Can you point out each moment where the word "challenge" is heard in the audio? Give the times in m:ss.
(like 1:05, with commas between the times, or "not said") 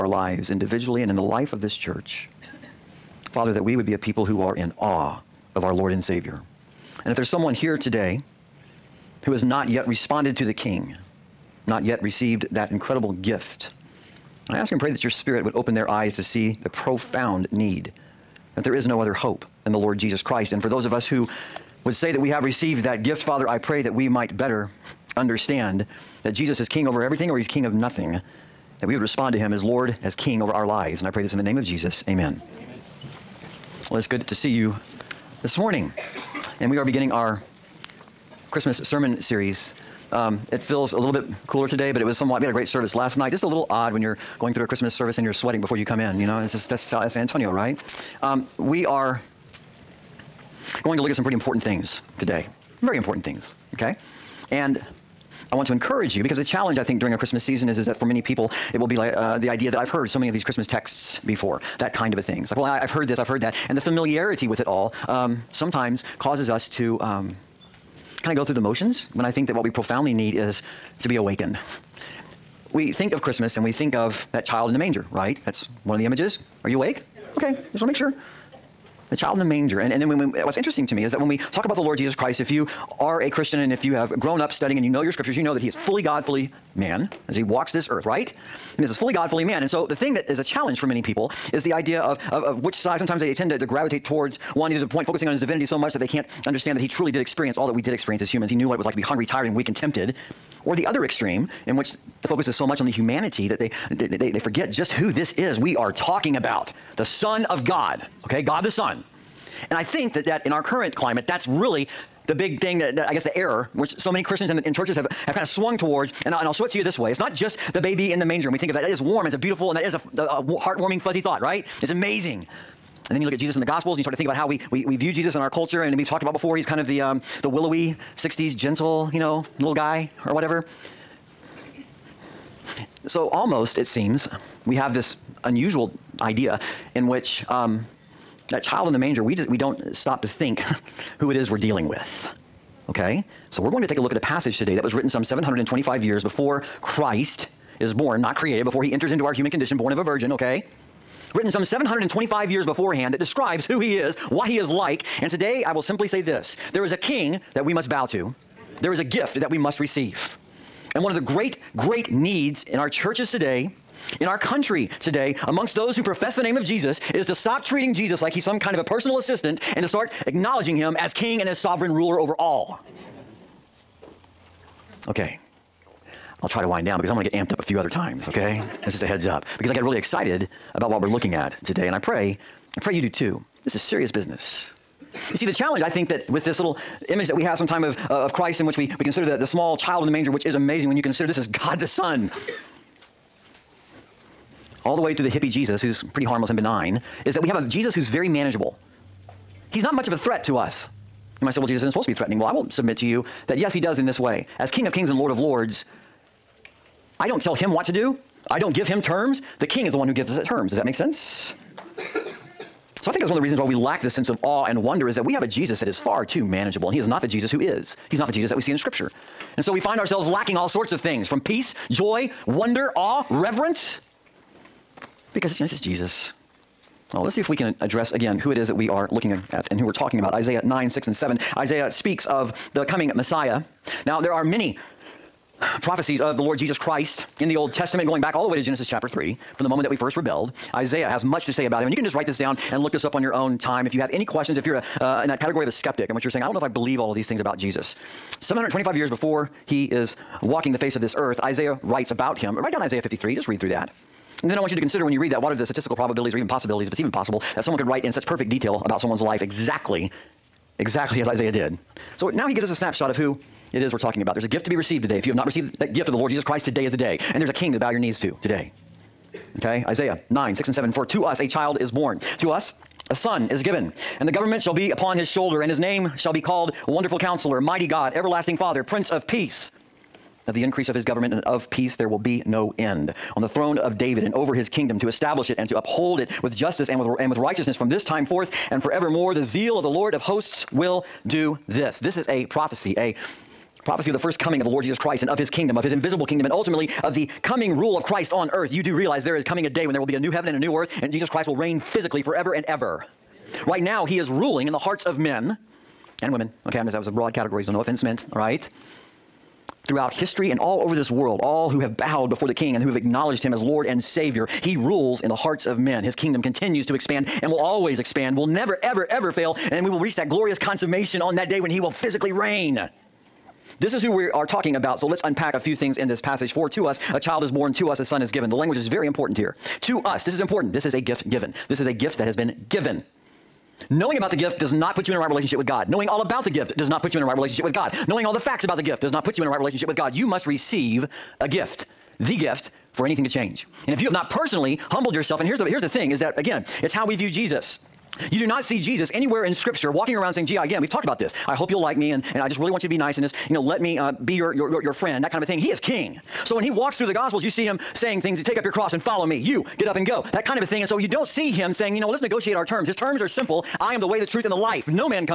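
0:56, 1:30, 3:05.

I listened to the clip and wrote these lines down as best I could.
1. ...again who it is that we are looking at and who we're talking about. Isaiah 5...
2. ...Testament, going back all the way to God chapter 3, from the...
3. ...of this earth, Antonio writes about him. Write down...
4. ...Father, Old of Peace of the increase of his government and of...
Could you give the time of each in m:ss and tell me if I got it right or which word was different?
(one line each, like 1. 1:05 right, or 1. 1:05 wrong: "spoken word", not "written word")
1. 3:48 wrong: "9", not "5"
2. 3:57 wrong: "Genesis", not "God"
3. 4:10 wrong: "Isaiah", not "Antonio"
4. 4:38 wrong: "Prince", not "Old".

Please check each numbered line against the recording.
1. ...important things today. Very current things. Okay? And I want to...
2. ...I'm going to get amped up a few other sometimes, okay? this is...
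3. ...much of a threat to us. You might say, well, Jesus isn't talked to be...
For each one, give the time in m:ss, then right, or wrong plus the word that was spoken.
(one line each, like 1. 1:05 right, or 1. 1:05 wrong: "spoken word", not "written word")
1. 0:51 wrong: "important", not "current"
2. 2:57 wrong: "times", not "sometimes"
3. 3:19 wrong: "supposed", not "talked".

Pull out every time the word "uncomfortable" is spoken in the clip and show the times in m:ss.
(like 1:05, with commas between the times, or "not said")
not said.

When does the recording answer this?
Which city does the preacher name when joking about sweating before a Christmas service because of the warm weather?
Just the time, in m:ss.
0:47.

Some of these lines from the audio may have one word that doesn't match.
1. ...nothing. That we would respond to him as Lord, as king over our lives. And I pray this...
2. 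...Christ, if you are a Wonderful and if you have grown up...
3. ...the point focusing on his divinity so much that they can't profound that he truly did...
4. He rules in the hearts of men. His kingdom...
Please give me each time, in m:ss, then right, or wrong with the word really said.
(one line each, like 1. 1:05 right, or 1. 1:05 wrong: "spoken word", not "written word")
1. 0:27 right
2. 1:22 wrong: "Christian", not "Wonderful"
3. 1:34 wrong: "understand", not "profound"
4. 5:14 right.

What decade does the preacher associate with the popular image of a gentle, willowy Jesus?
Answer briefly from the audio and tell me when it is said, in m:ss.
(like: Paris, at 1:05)
60s, at 2:08.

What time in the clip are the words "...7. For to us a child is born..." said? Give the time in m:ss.
4:30.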